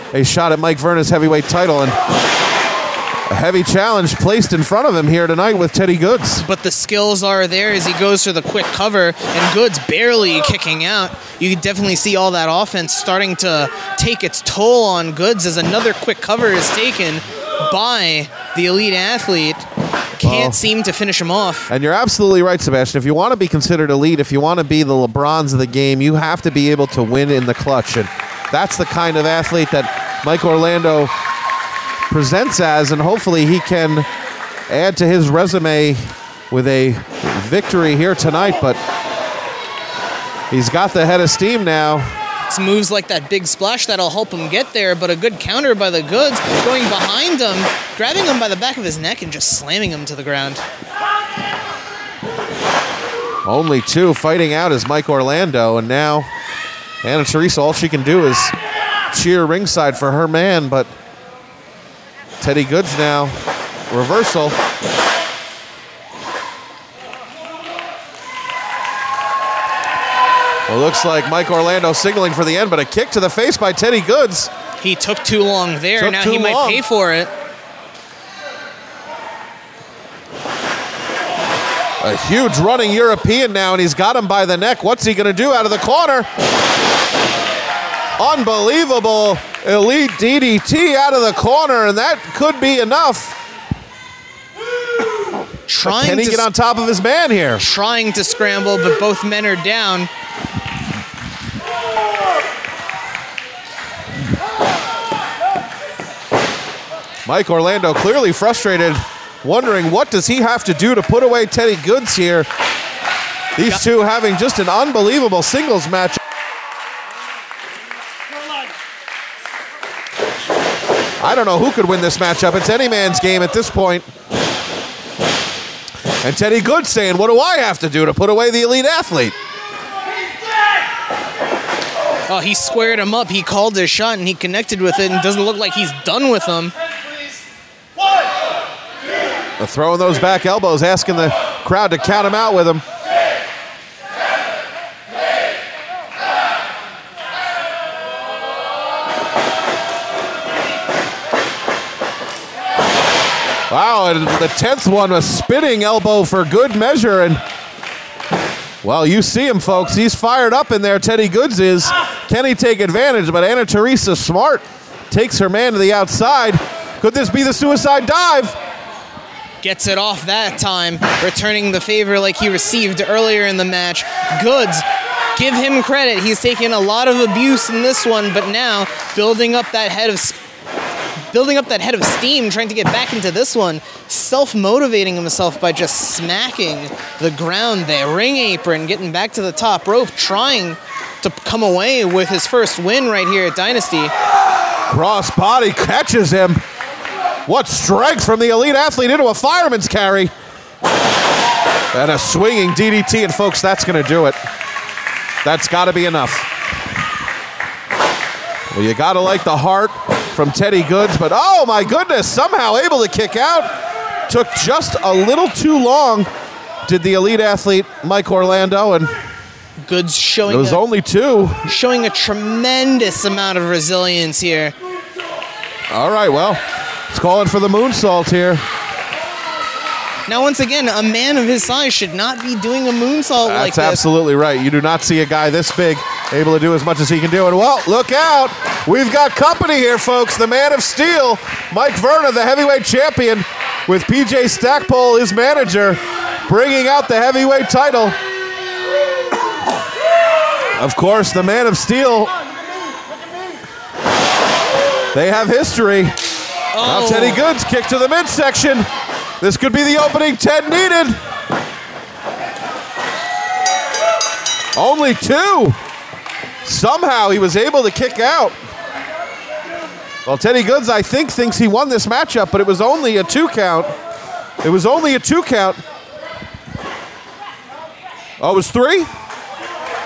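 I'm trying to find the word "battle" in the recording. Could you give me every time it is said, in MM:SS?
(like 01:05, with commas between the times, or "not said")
not said.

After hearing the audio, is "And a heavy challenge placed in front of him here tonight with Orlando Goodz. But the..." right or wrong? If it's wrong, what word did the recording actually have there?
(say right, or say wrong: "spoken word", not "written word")
wrong: "Teddy", not "Orlando".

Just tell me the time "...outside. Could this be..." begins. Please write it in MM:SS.
02:45.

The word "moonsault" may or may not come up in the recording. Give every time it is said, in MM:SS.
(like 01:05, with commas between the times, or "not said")
03:47, 03:52.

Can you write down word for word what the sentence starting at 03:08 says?
Ring apron, getting back to the top rope, trying to come away with his first win right here at Dynasty.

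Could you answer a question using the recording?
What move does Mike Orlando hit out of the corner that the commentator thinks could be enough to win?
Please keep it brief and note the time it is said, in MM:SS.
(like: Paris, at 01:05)
Elite DDT, at 01:29.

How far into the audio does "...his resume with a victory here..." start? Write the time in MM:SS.
00:35.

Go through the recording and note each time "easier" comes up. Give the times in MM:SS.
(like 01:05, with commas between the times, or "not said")
not said.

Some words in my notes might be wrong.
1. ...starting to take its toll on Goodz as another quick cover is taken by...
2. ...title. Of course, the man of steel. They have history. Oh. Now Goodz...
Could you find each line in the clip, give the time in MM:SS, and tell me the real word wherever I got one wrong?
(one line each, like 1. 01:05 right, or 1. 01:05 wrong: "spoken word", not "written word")
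1. 00:12 right
2. 04:07 wrong: "Teddy", not "Goodz".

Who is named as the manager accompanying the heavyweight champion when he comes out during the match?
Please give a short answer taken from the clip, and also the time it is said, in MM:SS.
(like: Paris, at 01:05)
PJ Stackpole, at 04:04.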